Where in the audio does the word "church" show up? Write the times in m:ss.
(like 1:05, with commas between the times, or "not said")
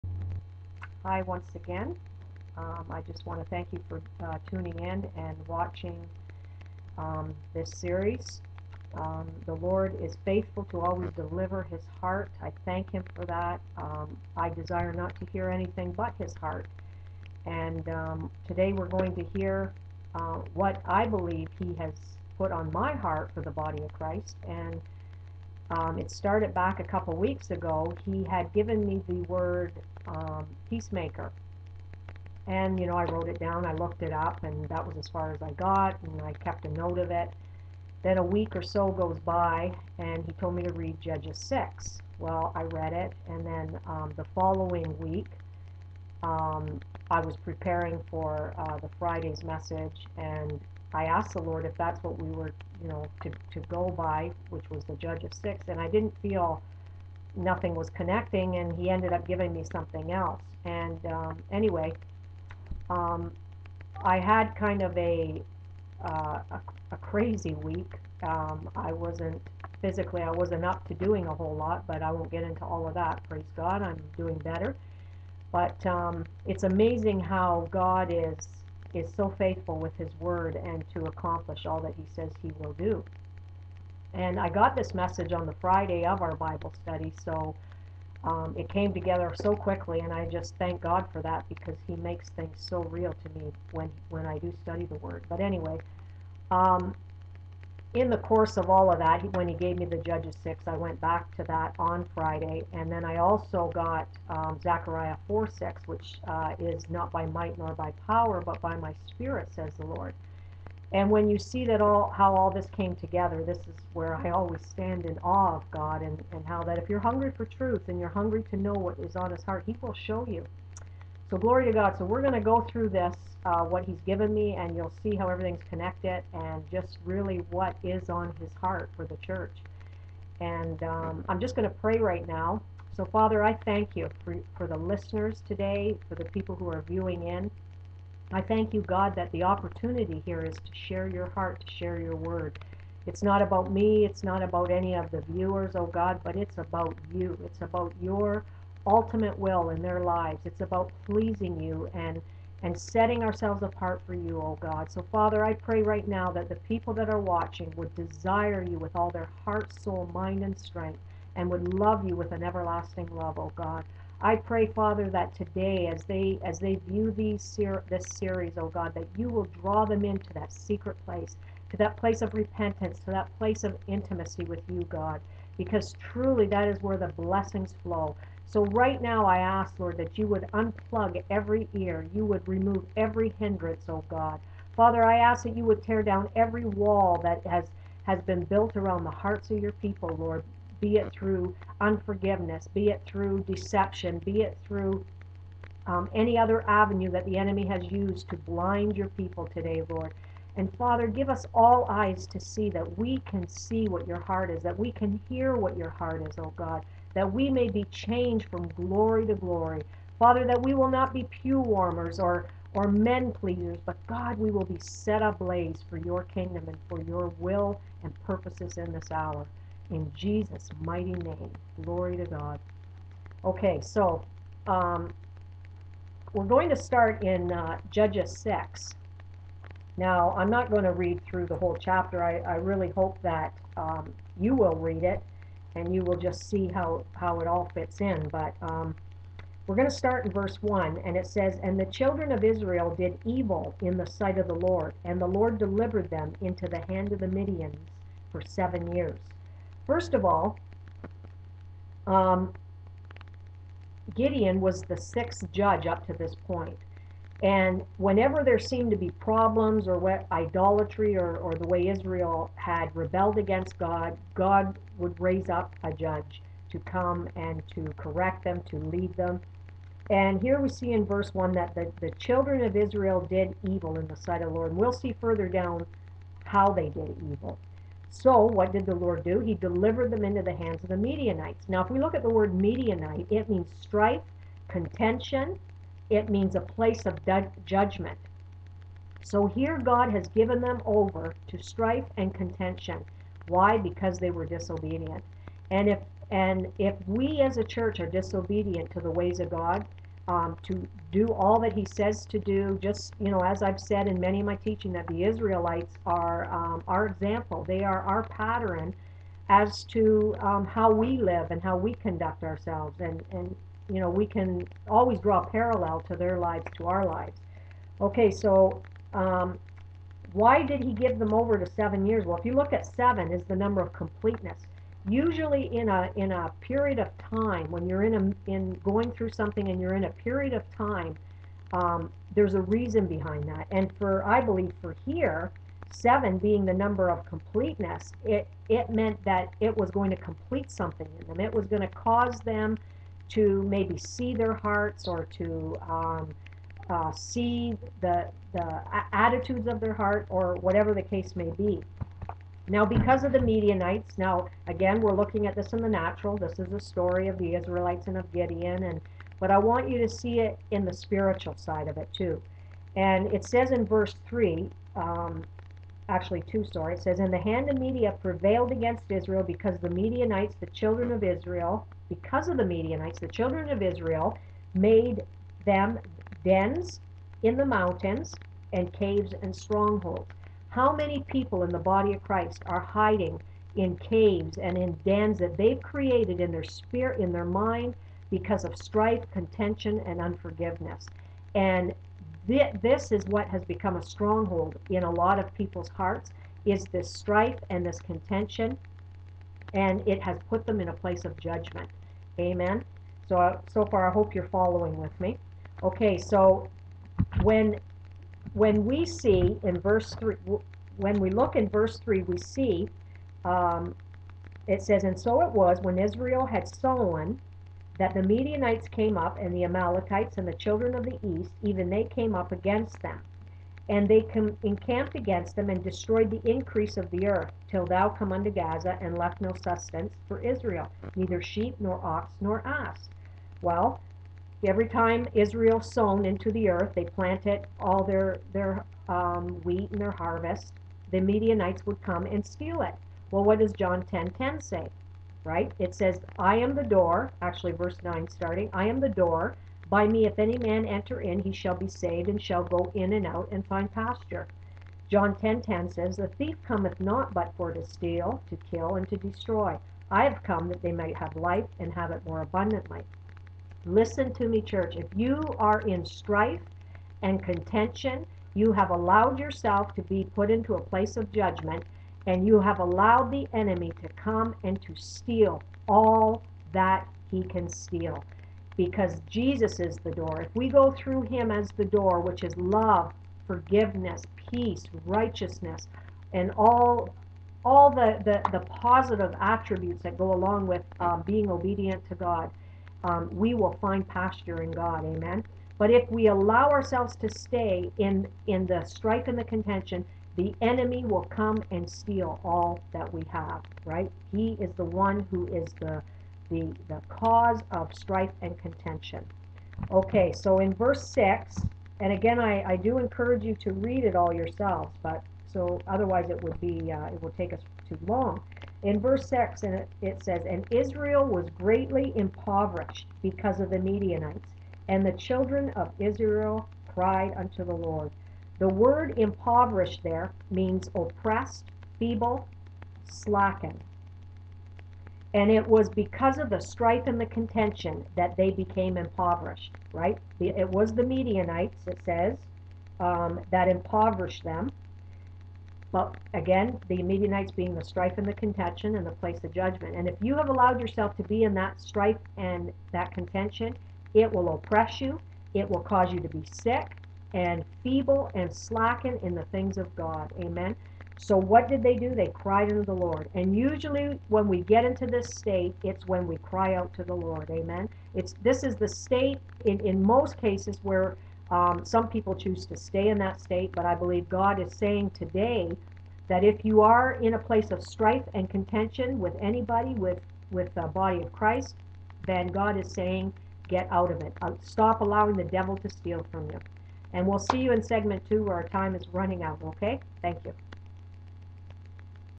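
2:09, 4:57, 7:44.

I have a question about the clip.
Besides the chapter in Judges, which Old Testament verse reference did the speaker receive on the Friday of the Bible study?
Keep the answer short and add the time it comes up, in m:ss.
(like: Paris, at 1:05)
Zechariah 4:6, at 1:44.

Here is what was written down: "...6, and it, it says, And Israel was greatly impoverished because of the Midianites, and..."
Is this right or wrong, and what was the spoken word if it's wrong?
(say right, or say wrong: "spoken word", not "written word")
right.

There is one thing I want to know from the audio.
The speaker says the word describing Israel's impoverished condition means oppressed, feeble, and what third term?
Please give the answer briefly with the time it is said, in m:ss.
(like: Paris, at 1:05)
Slackened, at 8:53.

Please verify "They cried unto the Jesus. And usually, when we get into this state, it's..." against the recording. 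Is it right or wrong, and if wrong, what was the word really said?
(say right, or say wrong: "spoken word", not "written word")
wrong: "Lord", not "Jesus".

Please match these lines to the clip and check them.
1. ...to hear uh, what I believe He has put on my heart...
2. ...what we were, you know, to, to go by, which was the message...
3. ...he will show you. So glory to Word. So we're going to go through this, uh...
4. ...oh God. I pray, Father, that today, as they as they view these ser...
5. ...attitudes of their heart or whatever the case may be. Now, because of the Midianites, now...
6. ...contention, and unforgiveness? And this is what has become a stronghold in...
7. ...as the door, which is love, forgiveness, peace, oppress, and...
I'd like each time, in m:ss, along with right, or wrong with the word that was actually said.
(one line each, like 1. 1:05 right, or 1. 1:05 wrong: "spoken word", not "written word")
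1. 0:19 right
2. 0:52 wrong: "judge", not "message"
3. 1:59 wrong: "God", not "Word"
4. 2:43 right
5. 5:49 right
6. 6:29 right
7. 8:01 wrong: "righteousness", not "oppress".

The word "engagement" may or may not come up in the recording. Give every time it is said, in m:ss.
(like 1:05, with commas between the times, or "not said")
not said.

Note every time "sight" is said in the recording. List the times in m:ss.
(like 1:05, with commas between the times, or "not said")
4:04, 4:34.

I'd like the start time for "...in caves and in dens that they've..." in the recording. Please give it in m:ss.
6:23.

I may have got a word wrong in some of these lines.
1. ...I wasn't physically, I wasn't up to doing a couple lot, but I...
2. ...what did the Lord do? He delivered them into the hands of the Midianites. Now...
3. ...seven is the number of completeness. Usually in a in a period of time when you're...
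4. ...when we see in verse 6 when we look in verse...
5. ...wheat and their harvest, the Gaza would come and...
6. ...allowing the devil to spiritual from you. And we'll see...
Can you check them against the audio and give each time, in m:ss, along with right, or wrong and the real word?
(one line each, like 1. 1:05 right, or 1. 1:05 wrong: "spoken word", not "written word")
1. 1:08 wrong: "whole", not "couple"
2. 4:38 right
3. 5:22 right
4. 6:48 wrong: "3", not "6"
5. 7:19 wrong: "Midianites", not "Gaza"
6. 9:45 wrong: "steal", not "spiritual".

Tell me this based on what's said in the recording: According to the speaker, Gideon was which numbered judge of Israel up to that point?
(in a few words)
Sixth.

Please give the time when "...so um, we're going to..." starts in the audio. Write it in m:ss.
3:43.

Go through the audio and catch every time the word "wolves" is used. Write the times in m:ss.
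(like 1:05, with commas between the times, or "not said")
not said.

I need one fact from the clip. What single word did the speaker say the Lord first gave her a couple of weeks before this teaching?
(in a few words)
Peacemaker.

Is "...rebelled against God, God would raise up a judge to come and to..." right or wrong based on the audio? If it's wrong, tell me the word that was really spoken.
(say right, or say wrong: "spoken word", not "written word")
right.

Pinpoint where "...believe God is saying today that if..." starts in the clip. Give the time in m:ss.
9:33.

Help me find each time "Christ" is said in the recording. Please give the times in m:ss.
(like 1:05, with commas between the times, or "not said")
0:23, 6:22, 9:41.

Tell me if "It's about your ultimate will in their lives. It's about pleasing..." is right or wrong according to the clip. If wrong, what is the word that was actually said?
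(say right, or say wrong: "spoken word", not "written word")
right.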